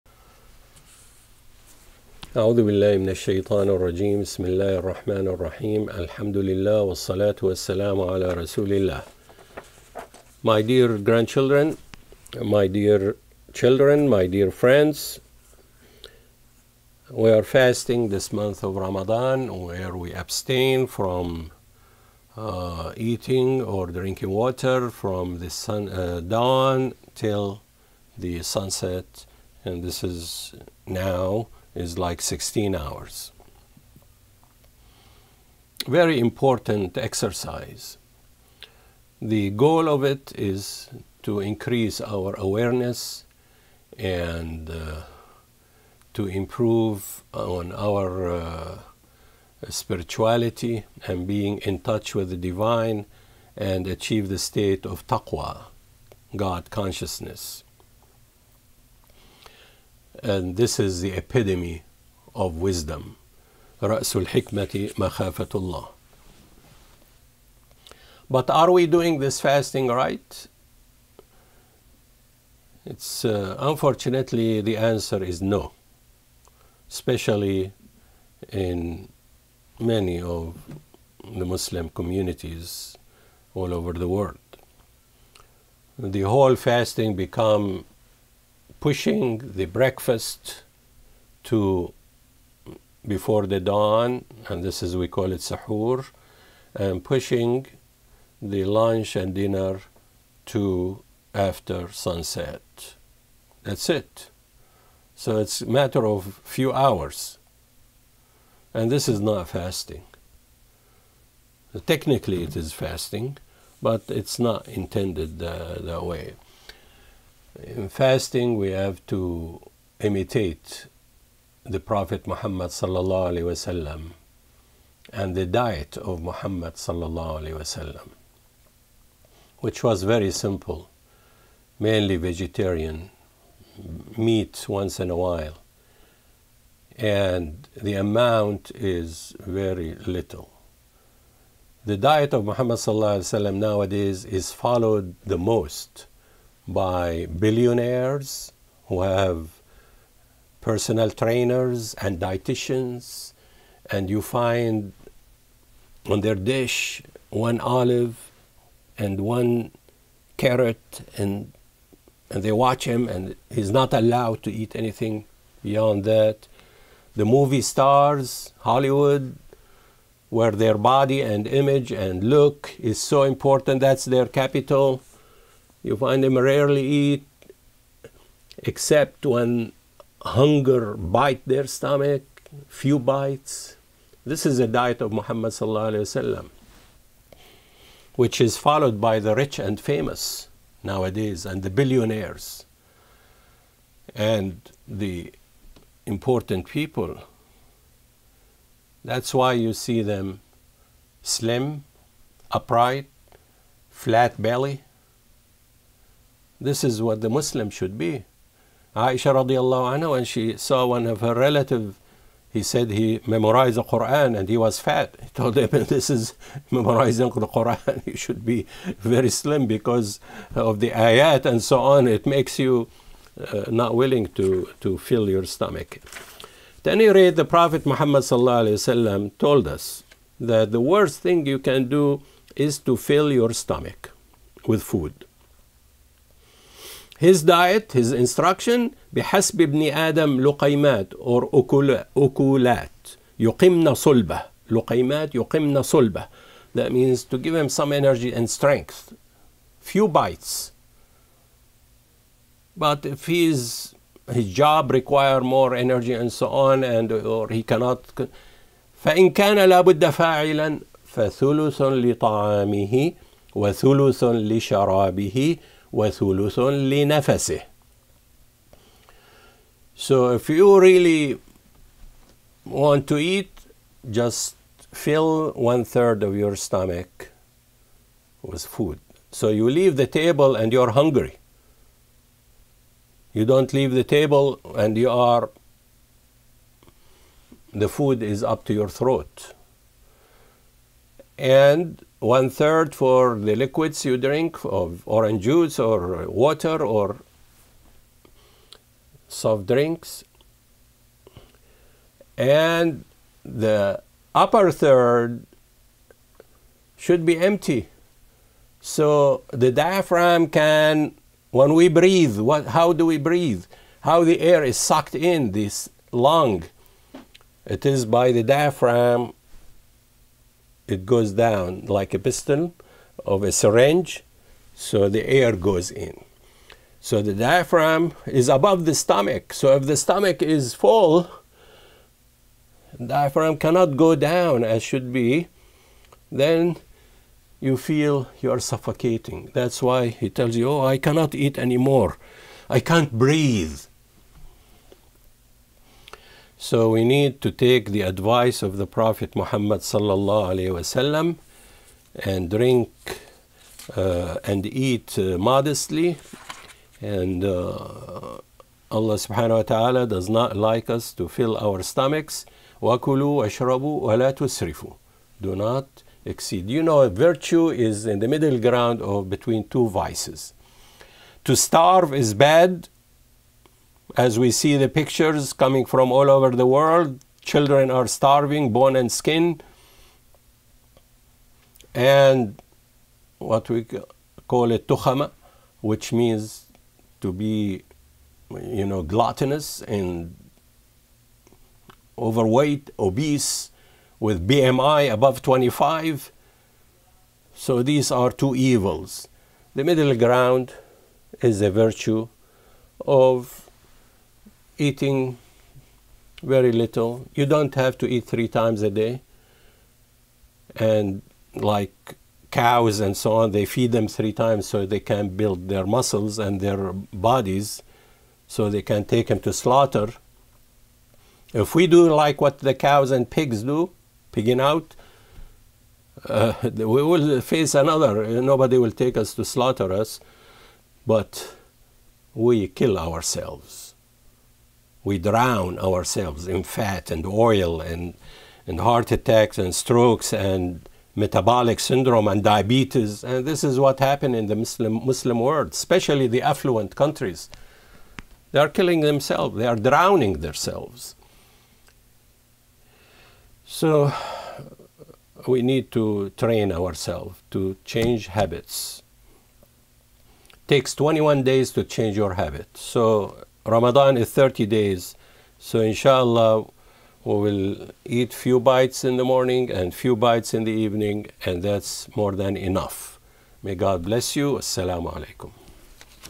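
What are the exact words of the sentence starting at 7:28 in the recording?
They are killing themselves, they are drowning themselves.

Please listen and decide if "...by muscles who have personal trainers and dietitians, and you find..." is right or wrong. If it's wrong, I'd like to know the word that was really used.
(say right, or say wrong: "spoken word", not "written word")
wrong: "billionaires", not "muscles".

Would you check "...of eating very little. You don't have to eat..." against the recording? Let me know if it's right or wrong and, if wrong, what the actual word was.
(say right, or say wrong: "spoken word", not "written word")
right.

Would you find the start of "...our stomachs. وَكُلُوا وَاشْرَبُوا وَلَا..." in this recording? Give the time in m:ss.
6:01.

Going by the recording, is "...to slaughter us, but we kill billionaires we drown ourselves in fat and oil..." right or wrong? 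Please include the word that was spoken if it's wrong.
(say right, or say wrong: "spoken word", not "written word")
wrong: "ourselves", not "billionaires".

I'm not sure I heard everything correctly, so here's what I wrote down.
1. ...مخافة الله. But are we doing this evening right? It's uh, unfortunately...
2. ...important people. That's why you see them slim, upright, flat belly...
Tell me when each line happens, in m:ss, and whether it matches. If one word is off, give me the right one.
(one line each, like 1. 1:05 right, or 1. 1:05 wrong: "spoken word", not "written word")
1. 1:04 wrong: "fasting", not "evening"
2. 3:16 right.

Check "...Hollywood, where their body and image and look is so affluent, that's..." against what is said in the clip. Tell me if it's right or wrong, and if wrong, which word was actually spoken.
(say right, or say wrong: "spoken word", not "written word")
wrong: "important", not "affluent".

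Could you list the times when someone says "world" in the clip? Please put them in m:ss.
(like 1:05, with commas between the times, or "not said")
1:24, 6:16, 7:25.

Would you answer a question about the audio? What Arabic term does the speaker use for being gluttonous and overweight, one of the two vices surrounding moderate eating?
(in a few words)
tukhama.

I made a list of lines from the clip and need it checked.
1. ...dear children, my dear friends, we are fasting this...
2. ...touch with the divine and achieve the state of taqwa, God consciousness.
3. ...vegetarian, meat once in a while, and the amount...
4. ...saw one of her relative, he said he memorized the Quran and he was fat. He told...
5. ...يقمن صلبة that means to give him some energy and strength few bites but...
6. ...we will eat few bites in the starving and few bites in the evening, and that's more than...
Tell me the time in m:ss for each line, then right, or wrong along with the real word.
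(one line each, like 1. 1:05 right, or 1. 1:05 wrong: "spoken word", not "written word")
1. 0:12 right
2. 0:51 right
3. 2:12 right
4. 3:30 right
5. 4:05 right
6. 7:47 wrong: "morning", not "starving".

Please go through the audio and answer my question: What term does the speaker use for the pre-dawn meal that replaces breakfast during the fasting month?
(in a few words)
sahur.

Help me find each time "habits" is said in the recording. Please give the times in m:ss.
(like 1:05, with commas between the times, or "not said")
7:38, 7:42.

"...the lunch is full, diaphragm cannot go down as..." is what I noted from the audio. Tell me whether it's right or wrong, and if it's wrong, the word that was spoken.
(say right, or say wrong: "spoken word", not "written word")
wrong: "stomach", not "lunch".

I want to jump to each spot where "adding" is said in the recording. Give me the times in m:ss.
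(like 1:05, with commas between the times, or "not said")
not said.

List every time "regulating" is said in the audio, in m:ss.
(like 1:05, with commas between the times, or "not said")
not said.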